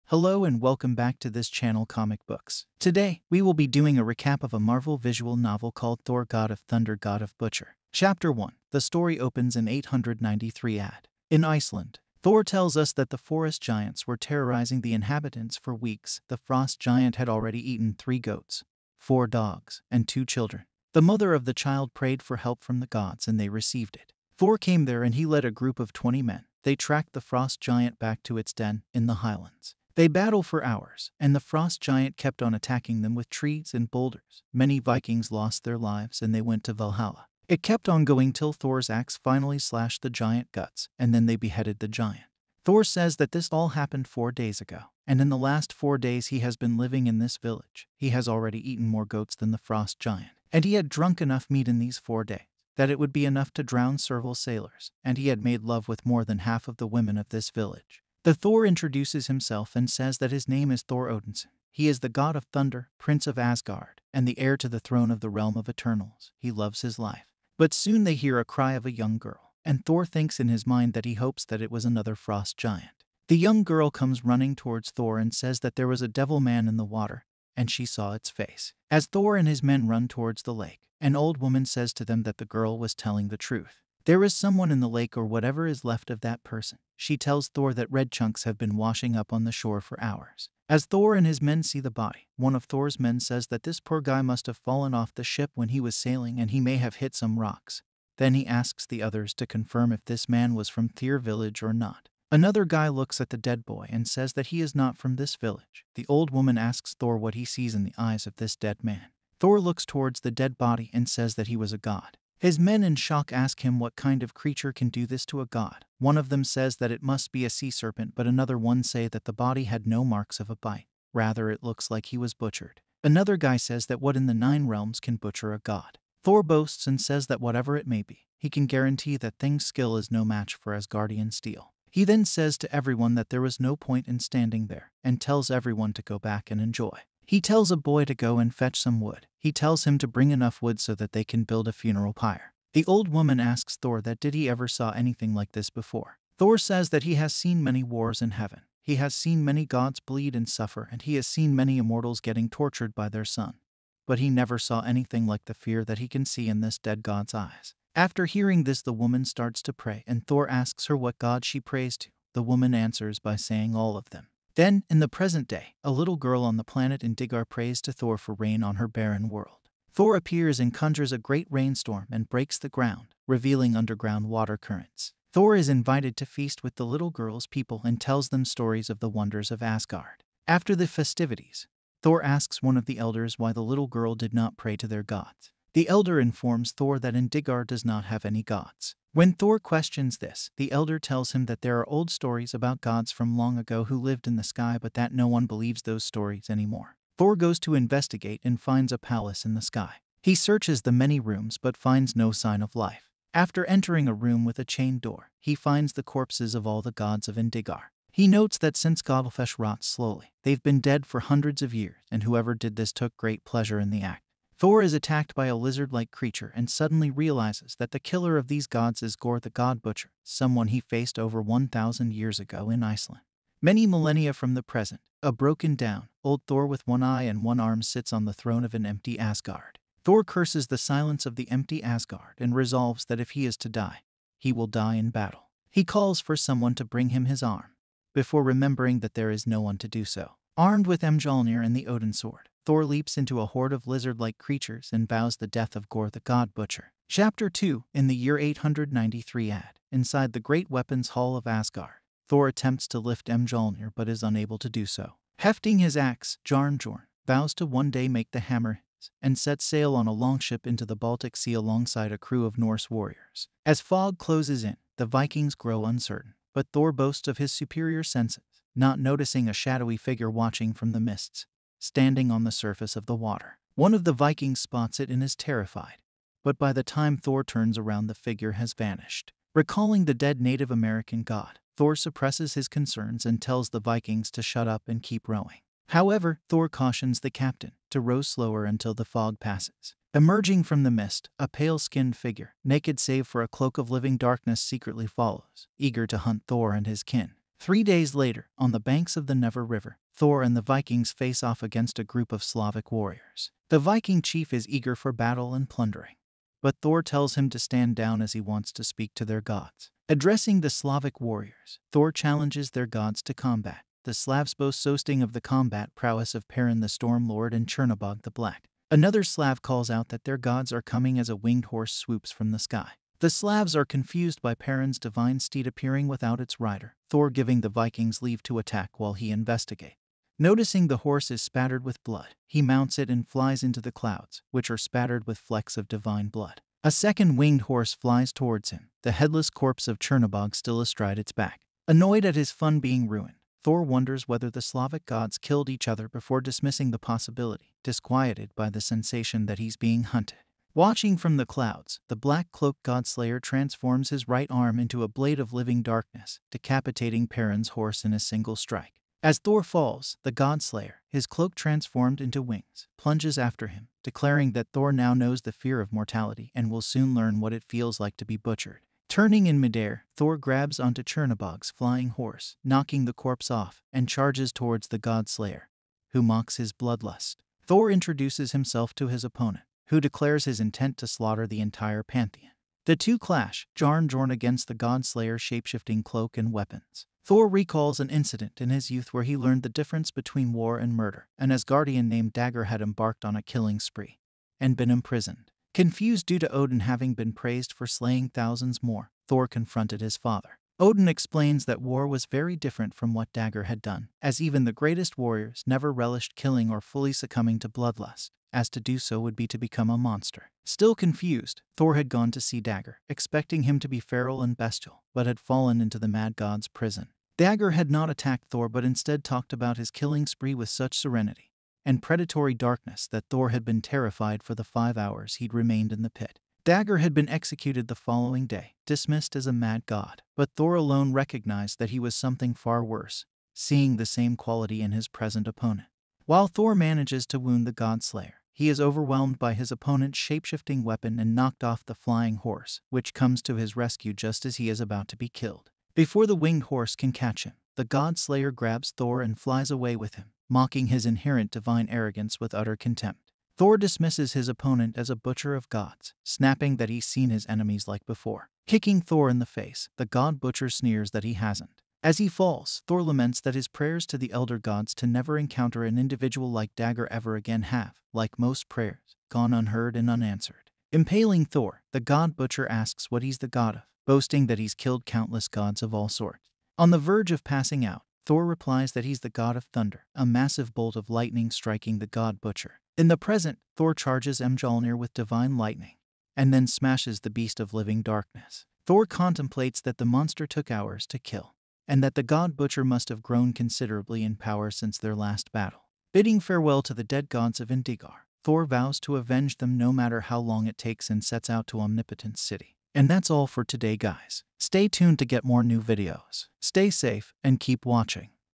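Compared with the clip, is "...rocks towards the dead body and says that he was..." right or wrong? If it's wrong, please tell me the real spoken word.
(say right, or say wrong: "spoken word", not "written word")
wrong: "looks", not "rocks".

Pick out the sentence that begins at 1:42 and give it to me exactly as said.
Another guy looks at the dead boy and says that he is not from this village.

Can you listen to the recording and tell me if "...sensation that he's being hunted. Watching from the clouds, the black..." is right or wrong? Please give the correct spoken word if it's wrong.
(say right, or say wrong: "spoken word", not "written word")
right.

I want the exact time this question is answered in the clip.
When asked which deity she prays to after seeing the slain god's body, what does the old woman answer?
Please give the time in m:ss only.
2:43.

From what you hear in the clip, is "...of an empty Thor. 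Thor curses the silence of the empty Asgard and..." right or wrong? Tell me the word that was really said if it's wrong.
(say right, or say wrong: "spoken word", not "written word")
wrong: "Asgard", not "Thor".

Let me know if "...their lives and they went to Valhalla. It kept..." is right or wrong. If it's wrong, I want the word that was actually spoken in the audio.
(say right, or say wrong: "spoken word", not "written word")
right.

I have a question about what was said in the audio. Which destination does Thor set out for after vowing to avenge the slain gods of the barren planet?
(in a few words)
Omnipotent City.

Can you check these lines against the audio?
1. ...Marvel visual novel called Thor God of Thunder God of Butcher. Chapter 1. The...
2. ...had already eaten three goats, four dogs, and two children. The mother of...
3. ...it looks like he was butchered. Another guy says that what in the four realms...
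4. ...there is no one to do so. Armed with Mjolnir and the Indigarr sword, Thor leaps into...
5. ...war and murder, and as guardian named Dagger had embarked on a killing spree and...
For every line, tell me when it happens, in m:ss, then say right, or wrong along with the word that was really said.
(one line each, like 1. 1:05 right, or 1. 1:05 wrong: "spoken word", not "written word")
1. 0:04 right
2. 0:17 right
3. 2:01 wrong: "nine", not "four"
4. 3:59 wrong: "Odin", not "Indigarr"
5. 6:30 right.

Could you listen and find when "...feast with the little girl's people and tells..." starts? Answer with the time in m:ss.
2:56.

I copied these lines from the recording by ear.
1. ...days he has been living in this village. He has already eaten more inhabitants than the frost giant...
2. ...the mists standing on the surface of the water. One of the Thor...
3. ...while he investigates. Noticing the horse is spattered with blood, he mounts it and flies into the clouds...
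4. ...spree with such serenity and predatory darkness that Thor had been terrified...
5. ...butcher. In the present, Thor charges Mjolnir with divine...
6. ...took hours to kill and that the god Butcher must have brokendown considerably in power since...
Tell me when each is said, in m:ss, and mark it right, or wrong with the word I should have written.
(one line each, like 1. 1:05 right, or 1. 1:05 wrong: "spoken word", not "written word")
1. 0:45 wrong: "goats", not "inhabitants"
2. 4:30 wrong: "Vikings", not "Thor"
3. 5:28 right
4. 7:00 right
5. 8:02 right
6. 8:10 wrong: "grown", not "brokendown".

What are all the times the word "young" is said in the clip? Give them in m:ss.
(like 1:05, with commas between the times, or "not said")
1:08, 1:13.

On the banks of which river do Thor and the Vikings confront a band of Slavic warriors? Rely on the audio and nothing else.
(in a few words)
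Neva River.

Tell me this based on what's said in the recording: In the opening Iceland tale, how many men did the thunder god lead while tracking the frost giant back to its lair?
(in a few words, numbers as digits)
20.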